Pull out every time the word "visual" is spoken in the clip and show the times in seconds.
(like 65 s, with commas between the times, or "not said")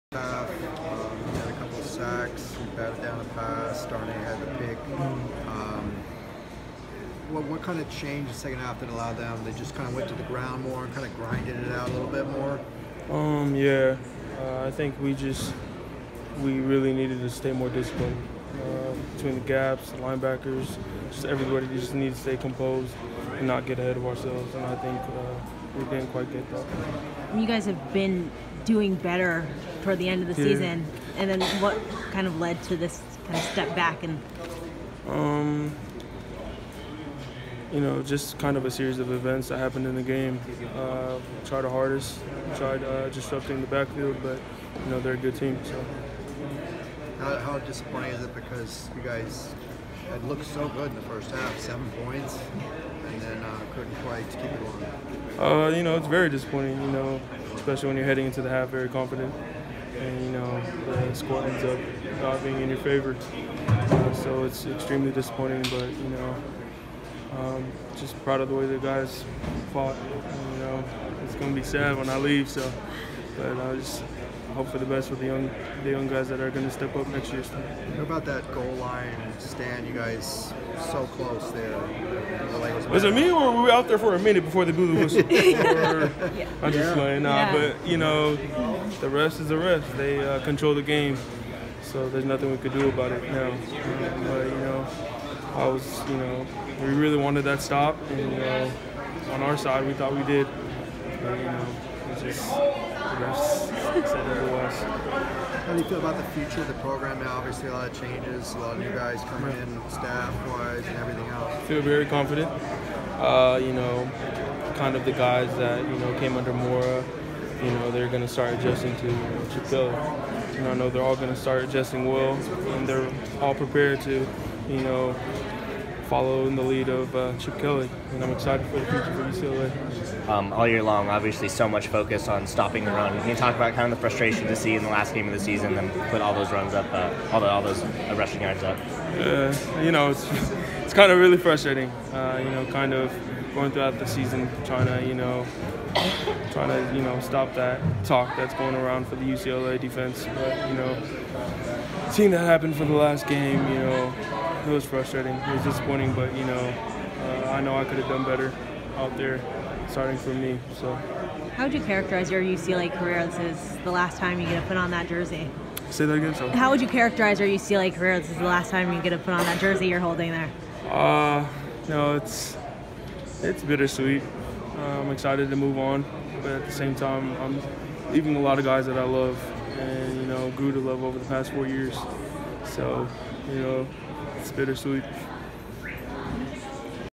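not said.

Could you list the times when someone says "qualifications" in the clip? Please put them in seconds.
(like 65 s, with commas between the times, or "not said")
not said.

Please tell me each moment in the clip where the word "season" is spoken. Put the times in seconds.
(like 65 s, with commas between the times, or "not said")
30 s, 135 s, 144 s.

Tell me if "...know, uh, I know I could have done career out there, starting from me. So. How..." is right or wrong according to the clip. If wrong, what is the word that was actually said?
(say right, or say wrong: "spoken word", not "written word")
wrong: "better", not "career".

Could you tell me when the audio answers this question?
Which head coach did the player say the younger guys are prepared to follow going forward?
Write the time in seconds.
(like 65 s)
127 s.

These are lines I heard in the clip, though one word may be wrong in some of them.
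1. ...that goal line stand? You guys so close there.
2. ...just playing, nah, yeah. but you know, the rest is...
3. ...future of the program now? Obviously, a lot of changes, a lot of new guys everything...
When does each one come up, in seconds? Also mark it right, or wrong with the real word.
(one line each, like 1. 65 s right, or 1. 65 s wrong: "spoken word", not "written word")
1. 78 s right
2. 86 s right
3. 106 s wrong: "coming", not "everything".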